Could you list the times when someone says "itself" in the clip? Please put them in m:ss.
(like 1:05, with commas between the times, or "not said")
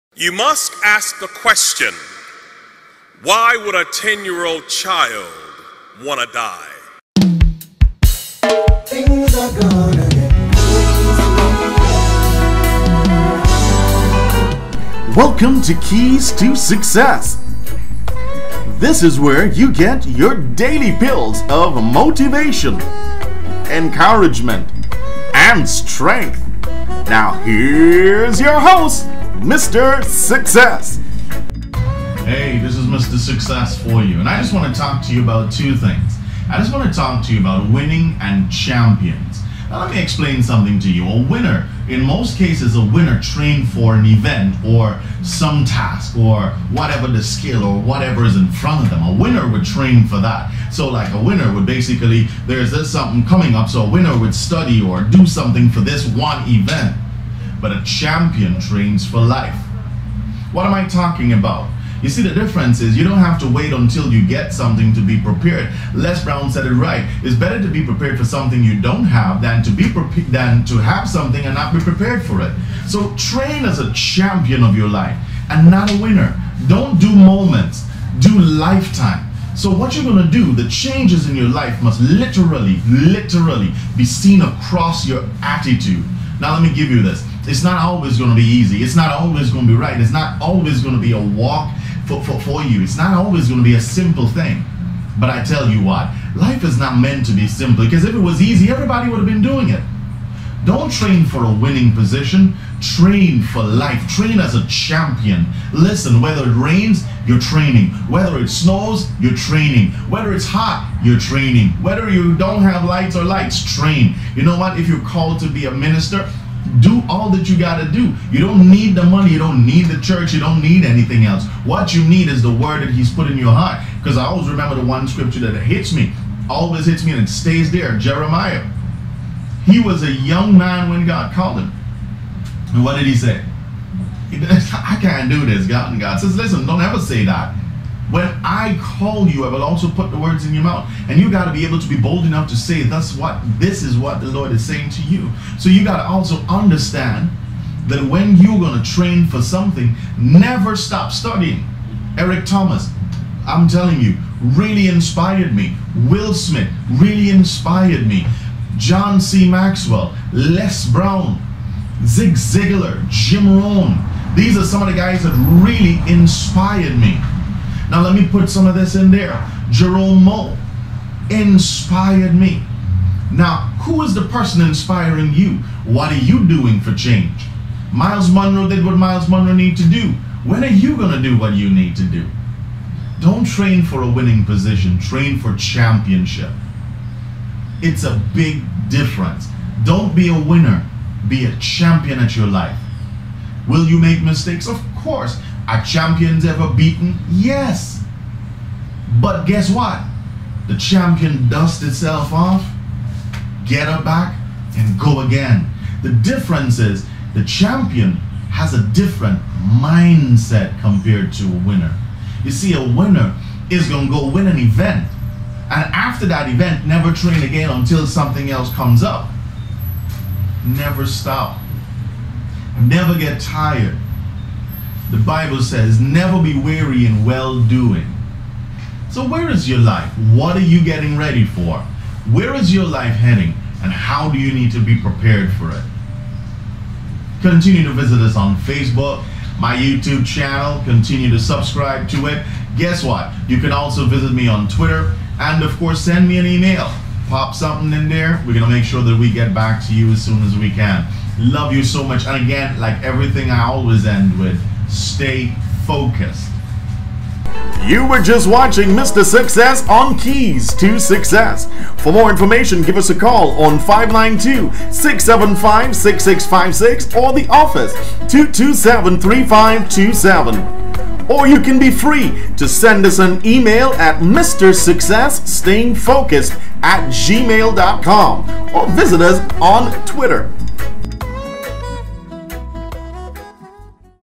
3:21.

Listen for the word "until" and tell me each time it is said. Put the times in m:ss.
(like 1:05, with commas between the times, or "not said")
1:03, 3:37.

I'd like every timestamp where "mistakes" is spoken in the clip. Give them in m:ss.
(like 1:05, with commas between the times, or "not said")
3:14.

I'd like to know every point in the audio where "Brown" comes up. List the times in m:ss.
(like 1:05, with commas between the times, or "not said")
1:06, 2:40.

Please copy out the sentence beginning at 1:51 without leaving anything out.
Whether you don't have lights or lights, train.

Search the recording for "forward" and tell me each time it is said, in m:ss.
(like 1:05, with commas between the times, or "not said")
not said.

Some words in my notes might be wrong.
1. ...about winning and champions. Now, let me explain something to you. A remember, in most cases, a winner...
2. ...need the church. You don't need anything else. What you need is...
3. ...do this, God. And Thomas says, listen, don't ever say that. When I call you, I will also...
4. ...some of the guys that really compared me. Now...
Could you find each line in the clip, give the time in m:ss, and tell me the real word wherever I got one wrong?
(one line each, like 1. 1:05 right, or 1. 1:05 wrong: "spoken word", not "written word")
1. 0:37 wrong: "winner", not "remember"
2. 1:59 right
3. 2:15 wrong: "God", not "Thomas"
4. 2:44 wrong: "inspired", not "compared".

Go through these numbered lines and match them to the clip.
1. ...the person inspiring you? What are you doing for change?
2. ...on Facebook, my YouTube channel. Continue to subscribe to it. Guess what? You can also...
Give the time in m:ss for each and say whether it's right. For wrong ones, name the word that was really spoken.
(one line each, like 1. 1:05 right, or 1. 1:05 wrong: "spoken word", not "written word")
1. 2:54 right
2. 3:58 right.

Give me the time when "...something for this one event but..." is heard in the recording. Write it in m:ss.
0:55.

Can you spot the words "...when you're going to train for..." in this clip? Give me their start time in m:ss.
2:28.